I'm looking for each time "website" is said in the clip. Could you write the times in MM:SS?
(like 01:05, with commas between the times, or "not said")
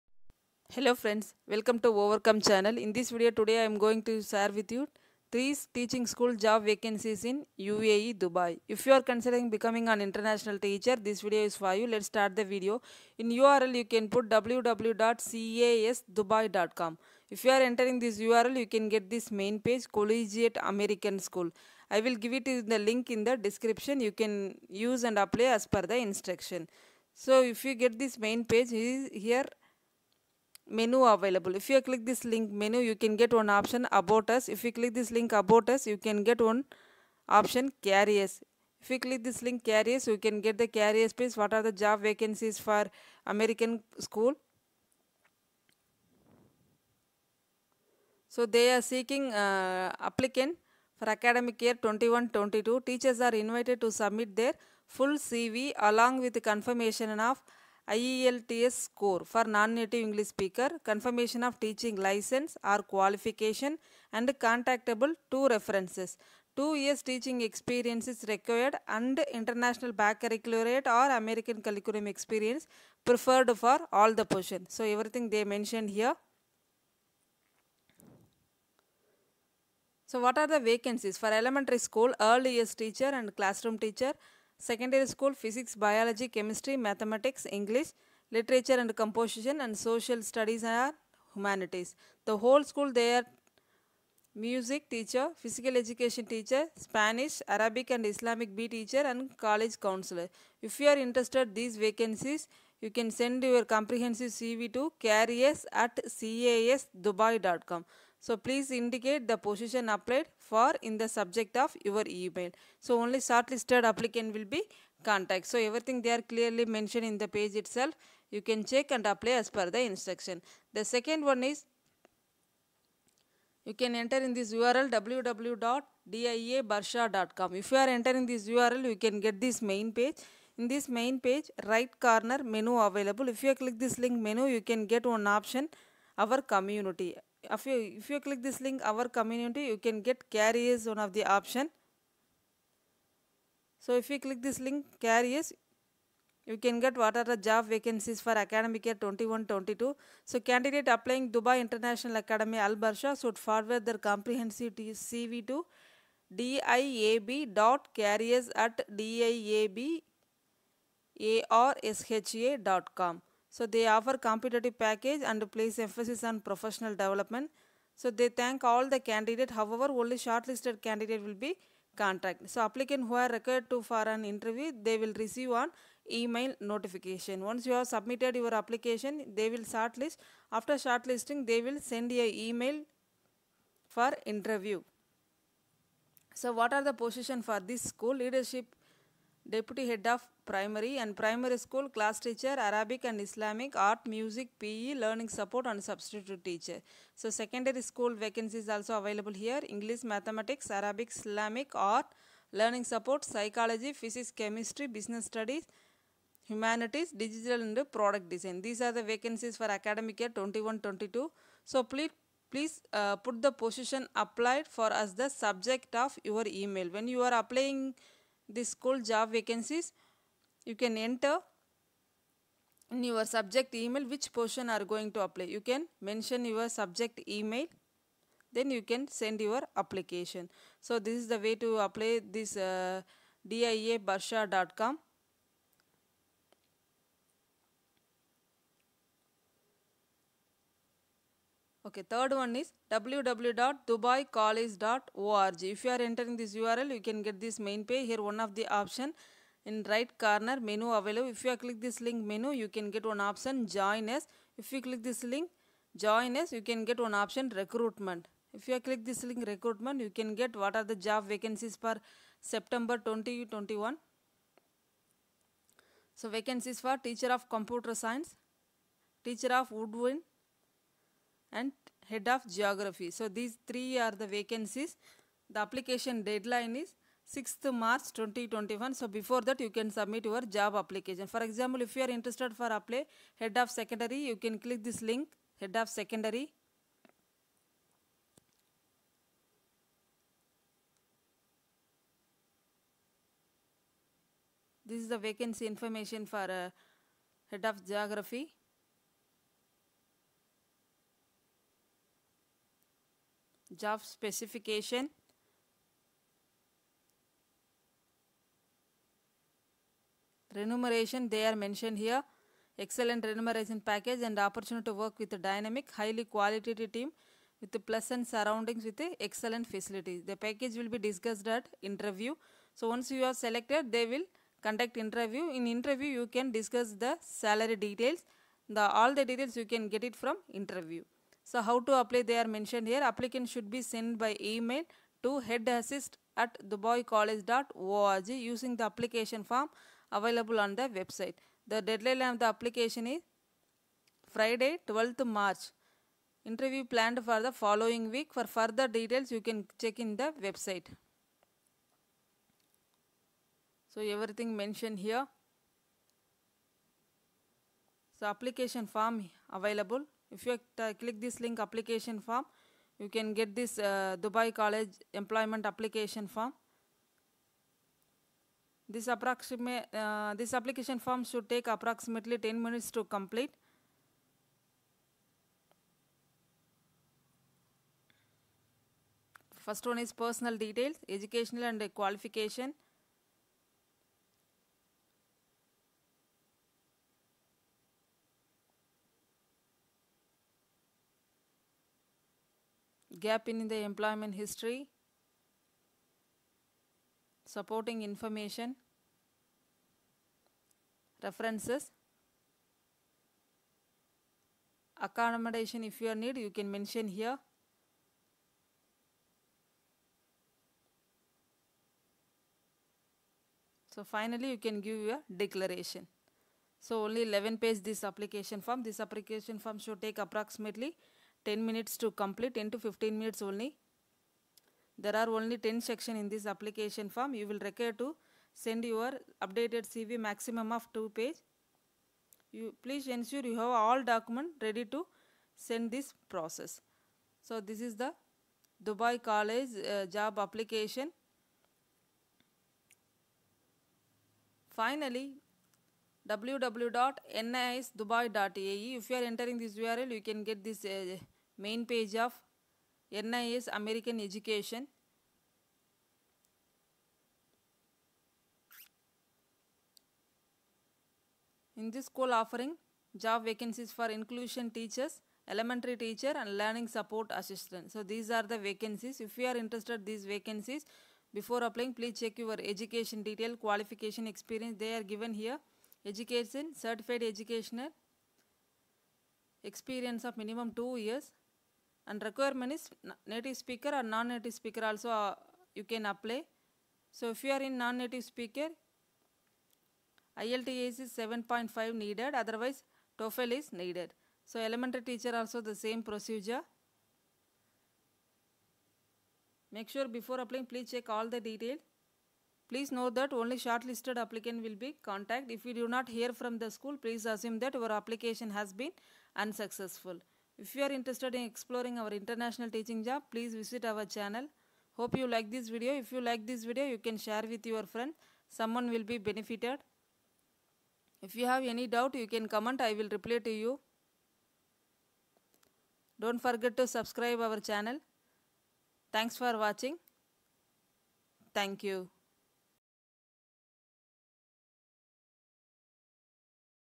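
05:40, 05:50.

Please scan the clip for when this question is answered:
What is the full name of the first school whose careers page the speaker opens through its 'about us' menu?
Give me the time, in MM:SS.
00:19.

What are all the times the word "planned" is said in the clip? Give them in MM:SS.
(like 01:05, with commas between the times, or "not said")
05:46.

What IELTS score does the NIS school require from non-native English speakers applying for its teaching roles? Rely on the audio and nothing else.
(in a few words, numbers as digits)
7.5.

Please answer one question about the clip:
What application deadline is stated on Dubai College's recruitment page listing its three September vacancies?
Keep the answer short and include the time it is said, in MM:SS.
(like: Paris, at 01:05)
6th March 2021, at 04:37.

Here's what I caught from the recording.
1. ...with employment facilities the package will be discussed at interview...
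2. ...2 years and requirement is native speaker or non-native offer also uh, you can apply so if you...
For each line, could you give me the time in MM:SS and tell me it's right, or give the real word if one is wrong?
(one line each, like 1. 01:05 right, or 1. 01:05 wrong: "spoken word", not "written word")
1. 05:18 wrong: "excellent", not "employment"
2. 08:00 wrong: "speaker", not "offer".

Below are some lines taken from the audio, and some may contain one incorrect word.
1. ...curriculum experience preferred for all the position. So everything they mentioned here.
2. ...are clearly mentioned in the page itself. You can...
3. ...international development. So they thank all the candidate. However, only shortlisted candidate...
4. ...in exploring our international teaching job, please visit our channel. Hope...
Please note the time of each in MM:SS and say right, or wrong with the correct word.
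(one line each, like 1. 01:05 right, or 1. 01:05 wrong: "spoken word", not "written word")
1. 01:11 right
2. 01:56 right
3. 02:46 wrong: "professional", not "international"
4. 08:31 right.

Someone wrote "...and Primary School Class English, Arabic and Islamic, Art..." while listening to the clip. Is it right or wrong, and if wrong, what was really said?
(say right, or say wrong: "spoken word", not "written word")
wrong: "Teacher", not "English".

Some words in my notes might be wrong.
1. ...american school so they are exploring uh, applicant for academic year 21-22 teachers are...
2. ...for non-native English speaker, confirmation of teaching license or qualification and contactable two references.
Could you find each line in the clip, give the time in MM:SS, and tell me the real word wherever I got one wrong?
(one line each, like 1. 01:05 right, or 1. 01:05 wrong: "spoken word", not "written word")
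1. 00:43 wrong: "seeking", not "exploring"
2. 00:59 right.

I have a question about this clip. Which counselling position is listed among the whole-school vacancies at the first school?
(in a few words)
College counselor.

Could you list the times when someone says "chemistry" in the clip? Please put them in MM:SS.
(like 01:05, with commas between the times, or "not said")
01:26, 03:24.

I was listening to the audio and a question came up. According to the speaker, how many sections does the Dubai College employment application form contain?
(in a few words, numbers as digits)
10.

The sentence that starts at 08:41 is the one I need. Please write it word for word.
If you have any doubt, you can comment.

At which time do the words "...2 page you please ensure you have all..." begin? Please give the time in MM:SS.
07:10.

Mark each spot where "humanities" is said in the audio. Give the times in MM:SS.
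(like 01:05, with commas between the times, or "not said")
01:31, 03:26.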